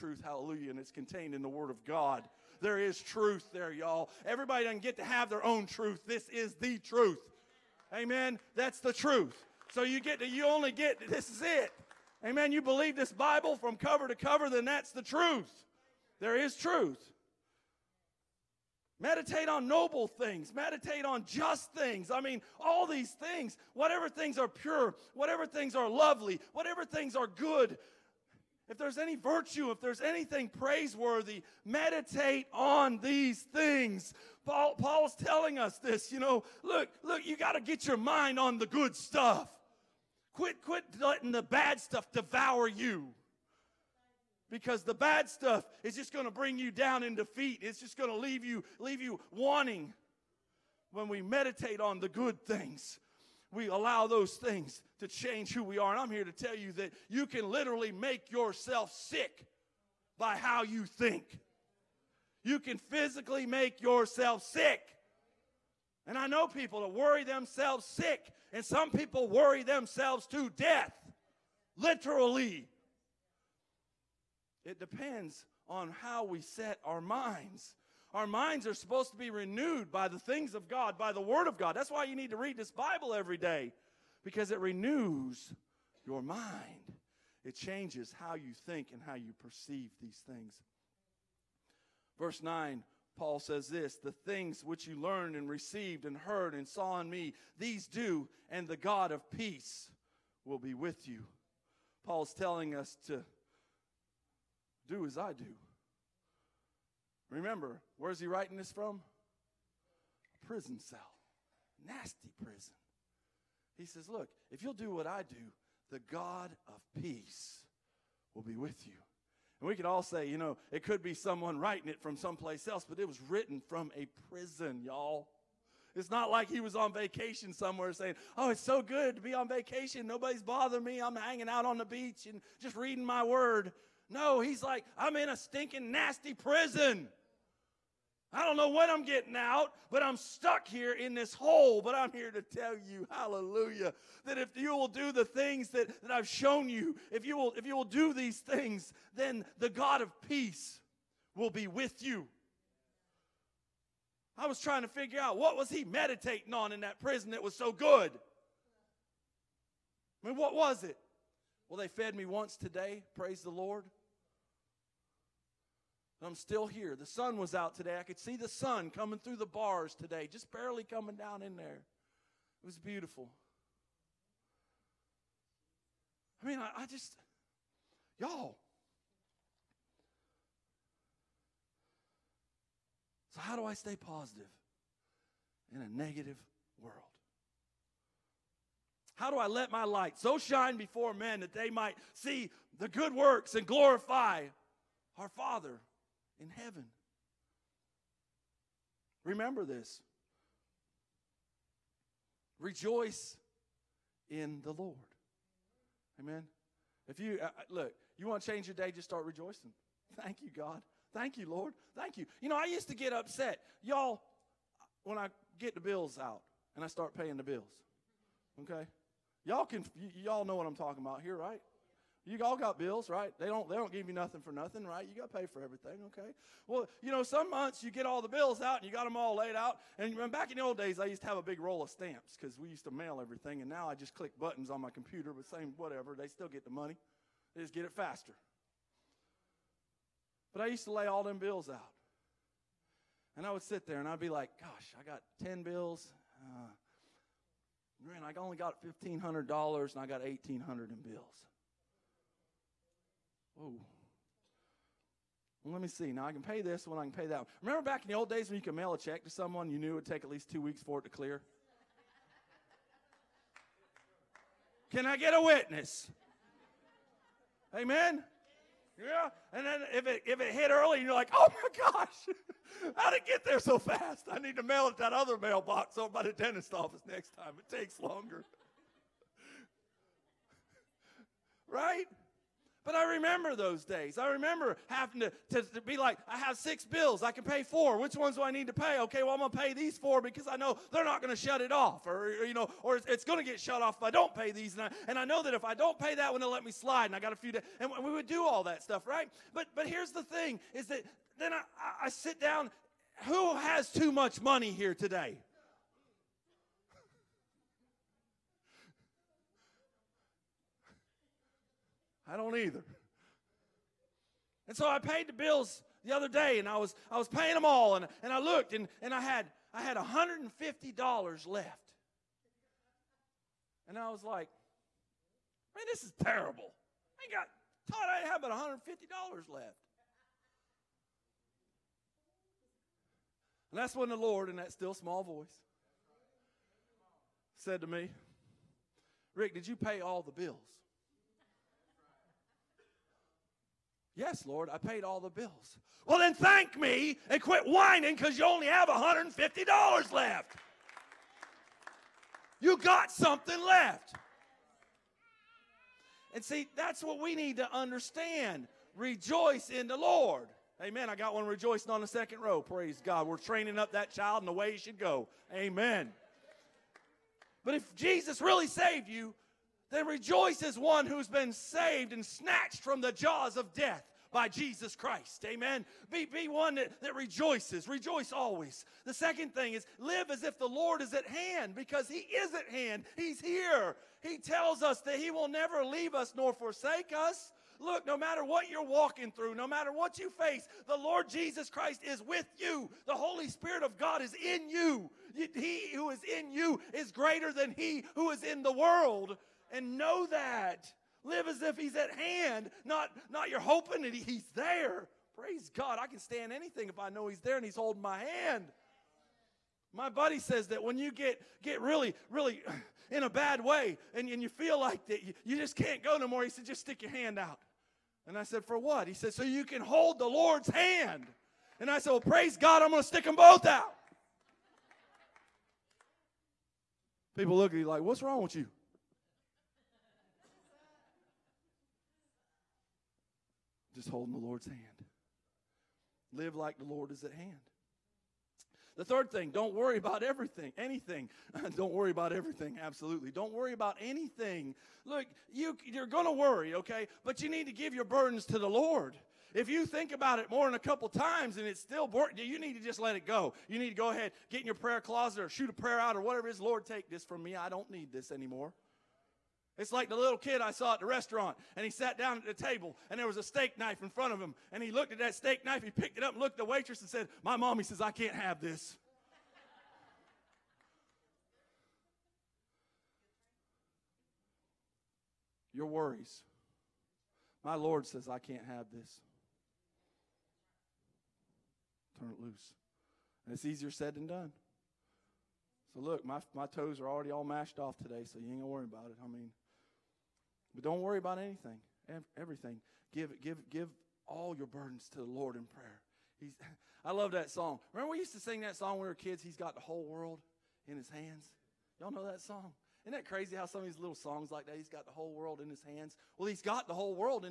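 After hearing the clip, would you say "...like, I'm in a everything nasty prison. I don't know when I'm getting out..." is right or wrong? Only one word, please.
wrong.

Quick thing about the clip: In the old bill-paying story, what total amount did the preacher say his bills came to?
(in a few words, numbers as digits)
$1,800.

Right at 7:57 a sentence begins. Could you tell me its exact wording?
My Lord says I can't have this.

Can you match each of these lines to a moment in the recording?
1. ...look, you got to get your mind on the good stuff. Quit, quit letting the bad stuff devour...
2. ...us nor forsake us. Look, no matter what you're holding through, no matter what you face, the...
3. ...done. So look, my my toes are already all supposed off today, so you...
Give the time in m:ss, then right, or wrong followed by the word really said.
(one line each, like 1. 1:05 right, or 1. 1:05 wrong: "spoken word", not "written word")
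1. 0:37 right
2. 6:26 wrong: "walking", not "holding"
3. 8:04 wrong: "mashed", not "supposed".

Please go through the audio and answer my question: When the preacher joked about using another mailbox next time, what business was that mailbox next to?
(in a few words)
Dentist office.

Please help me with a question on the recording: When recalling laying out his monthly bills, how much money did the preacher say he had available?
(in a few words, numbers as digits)
$1,500.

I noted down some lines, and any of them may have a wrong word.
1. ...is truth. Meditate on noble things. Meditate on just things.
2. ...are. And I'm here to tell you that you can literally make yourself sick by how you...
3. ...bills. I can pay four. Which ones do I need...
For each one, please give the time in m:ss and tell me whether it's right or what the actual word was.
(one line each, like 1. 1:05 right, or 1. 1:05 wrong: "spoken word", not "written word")
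1. 0:16 right
2. 0:55 right
3. 4:46 right.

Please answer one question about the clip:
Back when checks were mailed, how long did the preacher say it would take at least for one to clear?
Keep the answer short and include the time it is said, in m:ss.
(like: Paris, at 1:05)
Two weeks, at 4:20.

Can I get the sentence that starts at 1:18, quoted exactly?
Our minds are supposed to be renewed by the things of God, by the Word of God.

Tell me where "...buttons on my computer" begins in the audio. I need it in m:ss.
3:54.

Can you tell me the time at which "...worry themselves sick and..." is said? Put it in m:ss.
1:06.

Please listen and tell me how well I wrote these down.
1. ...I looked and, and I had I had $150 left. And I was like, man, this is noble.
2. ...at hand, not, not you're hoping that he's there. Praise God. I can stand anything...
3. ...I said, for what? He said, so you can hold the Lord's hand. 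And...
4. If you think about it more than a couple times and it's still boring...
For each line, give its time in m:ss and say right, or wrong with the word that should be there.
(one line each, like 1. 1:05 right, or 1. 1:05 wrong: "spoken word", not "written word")
1. 5:18 wrong: "terrible", not "noble"
2. 6:41 right
3. 6:58 right
4. 7:29 right.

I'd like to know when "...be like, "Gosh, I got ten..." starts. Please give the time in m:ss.
4:04.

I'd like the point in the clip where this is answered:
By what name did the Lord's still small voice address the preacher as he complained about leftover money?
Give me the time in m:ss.
5:39.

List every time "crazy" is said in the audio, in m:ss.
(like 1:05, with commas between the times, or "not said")
8:23.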